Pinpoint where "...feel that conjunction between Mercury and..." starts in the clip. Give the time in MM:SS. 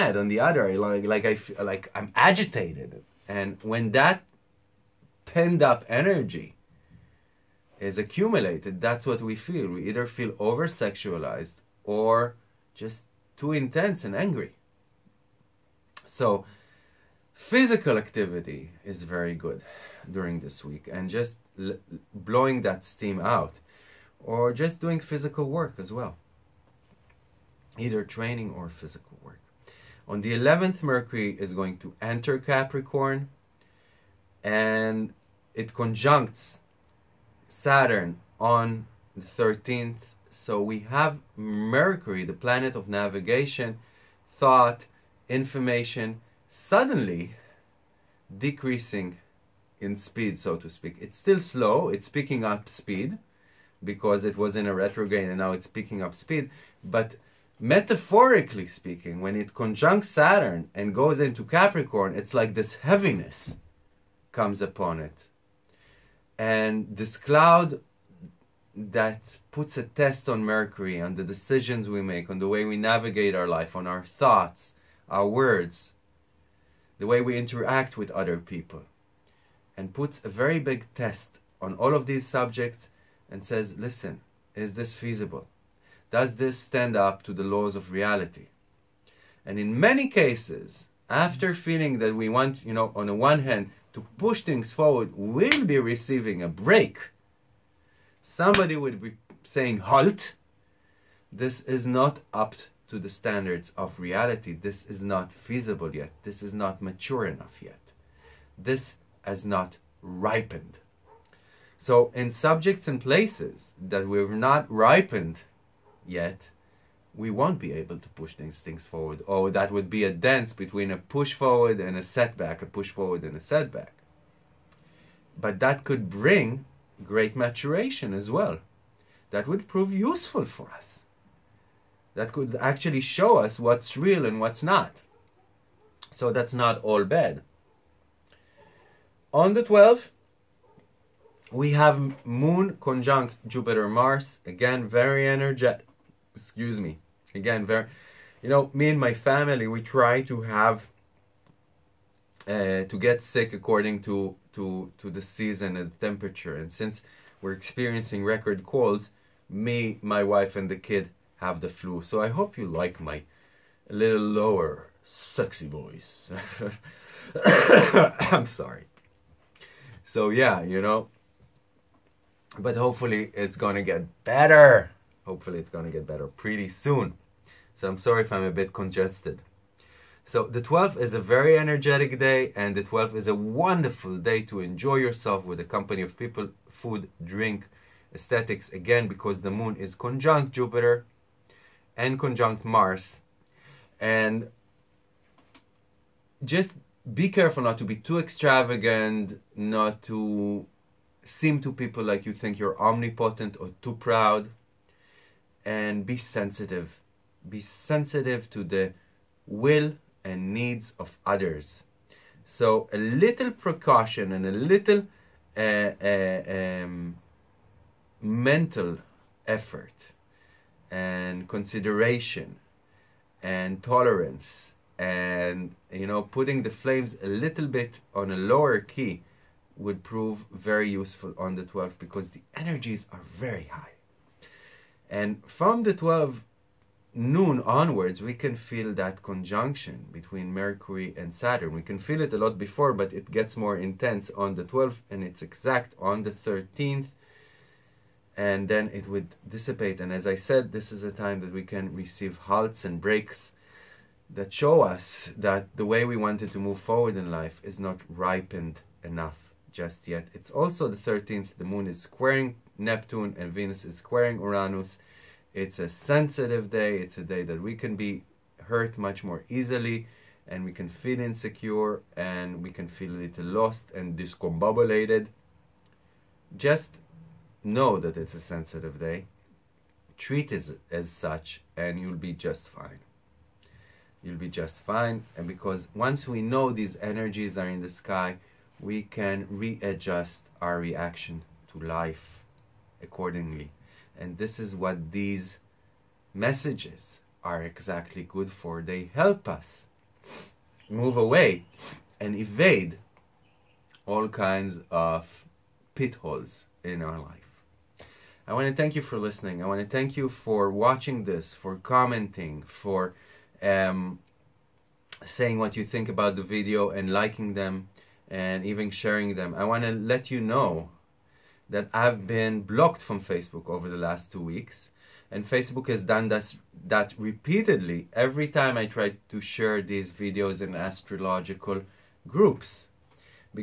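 03:58.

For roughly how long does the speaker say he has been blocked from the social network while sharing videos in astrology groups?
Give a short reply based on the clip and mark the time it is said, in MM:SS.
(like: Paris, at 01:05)
2 weeks, at 05:24.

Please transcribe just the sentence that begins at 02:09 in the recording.
That would prove useful for us.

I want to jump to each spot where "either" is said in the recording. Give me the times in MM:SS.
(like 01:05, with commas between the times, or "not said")
00:09, 00:27.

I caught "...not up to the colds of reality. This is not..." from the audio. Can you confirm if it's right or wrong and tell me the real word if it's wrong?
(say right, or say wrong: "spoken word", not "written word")
wrong: "standards", not "colds".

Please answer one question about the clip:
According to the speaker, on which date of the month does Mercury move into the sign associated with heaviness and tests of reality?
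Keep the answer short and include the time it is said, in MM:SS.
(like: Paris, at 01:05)
11th, at 00:30.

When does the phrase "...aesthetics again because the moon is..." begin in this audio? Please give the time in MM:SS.
03:08.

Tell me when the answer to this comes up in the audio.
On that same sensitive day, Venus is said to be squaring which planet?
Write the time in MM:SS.
04:24.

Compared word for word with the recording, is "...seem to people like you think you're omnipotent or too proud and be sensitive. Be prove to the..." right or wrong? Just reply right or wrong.
wrong.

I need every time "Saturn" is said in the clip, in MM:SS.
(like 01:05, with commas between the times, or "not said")
00:37, 01:00, 04:01.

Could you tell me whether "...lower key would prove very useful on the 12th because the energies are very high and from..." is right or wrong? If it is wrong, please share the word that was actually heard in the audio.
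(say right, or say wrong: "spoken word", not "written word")
right.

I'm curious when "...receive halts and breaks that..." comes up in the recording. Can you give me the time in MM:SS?
04:11.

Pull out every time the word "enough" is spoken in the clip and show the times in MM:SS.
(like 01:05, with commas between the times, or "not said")
01:47, 04:19.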